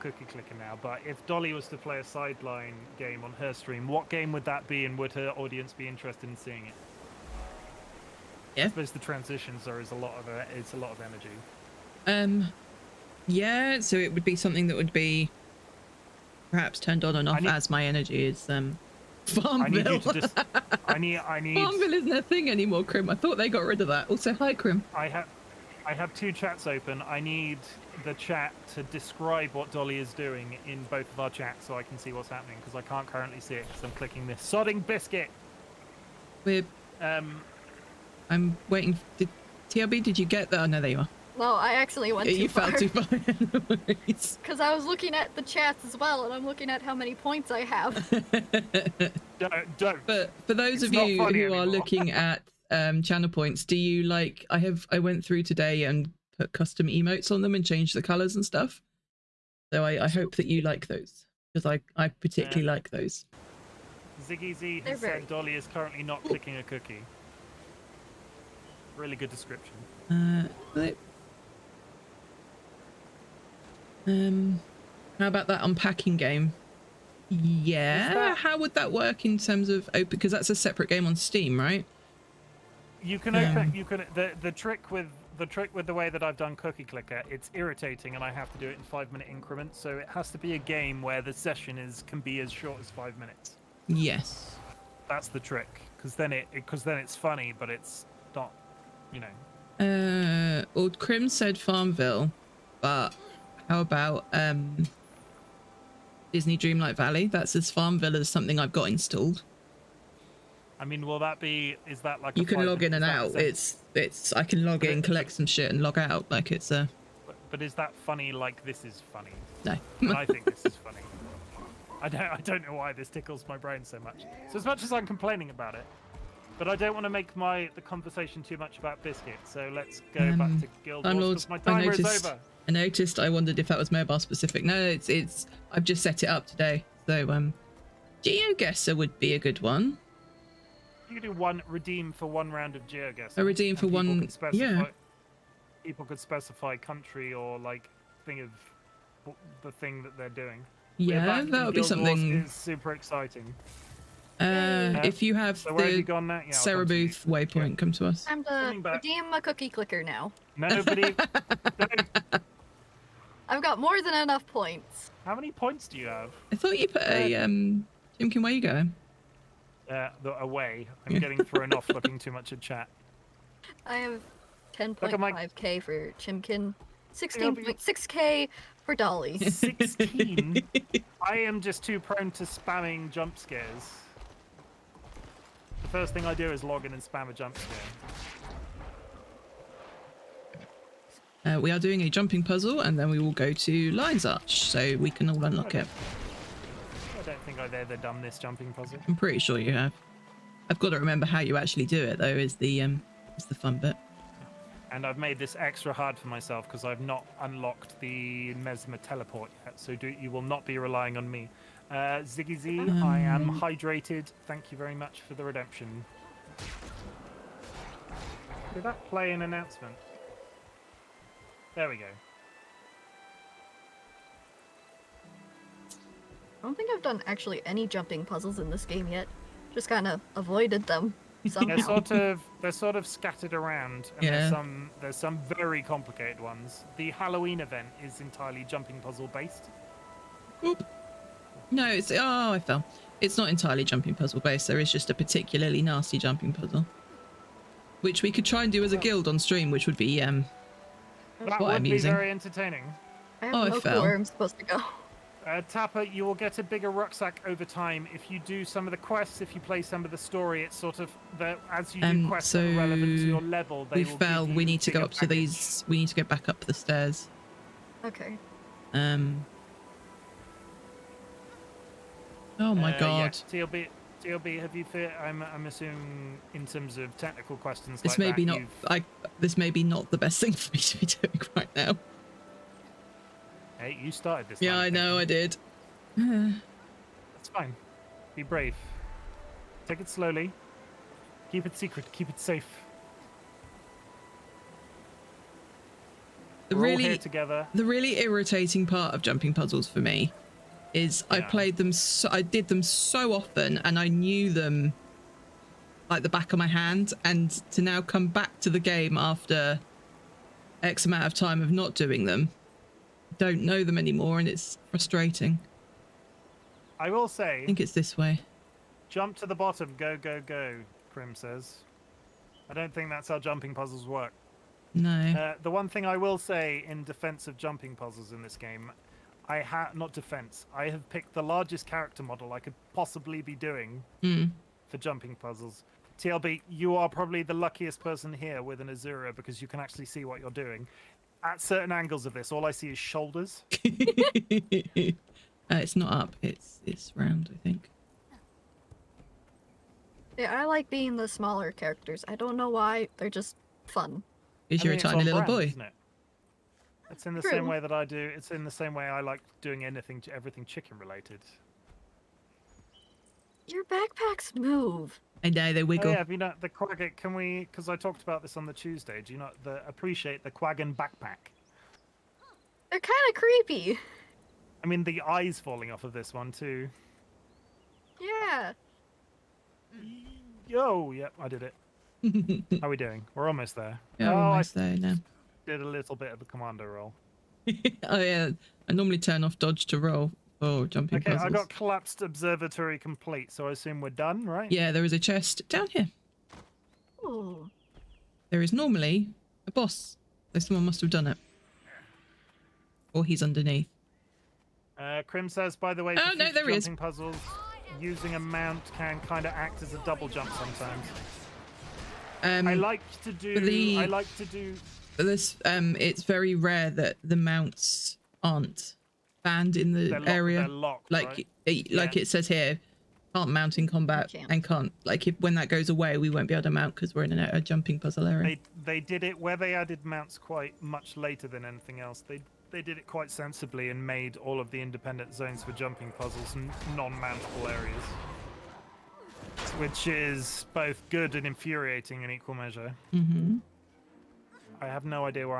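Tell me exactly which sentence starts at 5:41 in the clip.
At certain angles of this, all I see is shoulders.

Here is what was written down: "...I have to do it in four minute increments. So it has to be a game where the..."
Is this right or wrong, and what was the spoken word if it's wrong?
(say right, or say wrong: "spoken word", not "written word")
wrong: "five", not "four".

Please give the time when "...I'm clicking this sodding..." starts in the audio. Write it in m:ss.
0:33.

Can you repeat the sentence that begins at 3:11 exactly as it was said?
Uh, we are doing a jumping puzzle and then we will go to Lion's Arch so we can all unlock okay.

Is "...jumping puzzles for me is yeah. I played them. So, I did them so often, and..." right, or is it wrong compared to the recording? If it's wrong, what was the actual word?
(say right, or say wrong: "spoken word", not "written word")
right.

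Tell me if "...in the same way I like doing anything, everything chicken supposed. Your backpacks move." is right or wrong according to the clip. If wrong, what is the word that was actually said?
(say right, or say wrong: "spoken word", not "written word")
wrong: "related", not "supposed".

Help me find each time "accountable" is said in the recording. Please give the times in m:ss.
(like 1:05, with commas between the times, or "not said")
not said.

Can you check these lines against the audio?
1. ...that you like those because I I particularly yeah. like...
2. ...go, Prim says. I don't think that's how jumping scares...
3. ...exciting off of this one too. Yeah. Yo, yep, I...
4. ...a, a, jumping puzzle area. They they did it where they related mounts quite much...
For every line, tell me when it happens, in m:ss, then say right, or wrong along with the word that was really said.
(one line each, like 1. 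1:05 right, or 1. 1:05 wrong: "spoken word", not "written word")
1. 1:00 right
2. 5:20 wrong: "puzzles", not "scares"
3. 6:15 wrong: "falling", not "exciting"
4. 7:07 wrong: "added", not "related".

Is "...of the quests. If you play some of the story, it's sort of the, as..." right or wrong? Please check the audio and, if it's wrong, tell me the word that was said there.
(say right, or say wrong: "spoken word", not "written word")
right.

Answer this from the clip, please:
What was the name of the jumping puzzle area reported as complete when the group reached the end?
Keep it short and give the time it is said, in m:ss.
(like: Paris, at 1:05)
collapsed observatory, at 6:31.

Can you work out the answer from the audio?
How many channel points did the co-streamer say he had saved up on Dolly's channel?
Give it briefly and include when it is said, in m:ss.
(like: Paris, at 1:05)
16.6k, at 2:57.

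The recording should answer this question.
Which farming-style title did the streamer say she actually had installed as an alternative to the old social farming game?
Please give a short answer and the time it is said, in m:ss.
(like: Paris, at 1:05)
Disney Dreamlight Valley, at 1:46.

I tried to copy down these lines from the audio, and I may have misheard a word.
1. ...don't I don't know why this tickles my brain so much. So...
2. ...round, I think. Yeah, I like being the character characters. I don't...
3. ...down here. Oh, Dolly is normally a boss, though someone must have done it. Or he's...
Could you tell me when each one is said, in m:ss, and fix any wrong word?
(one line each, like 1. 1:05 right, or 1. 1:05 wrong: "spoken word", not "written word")
1. 2:02 right
2. 5:47 wrong: "smaller", not "character"
3. 6:35 wrong: "There", not "Dolly".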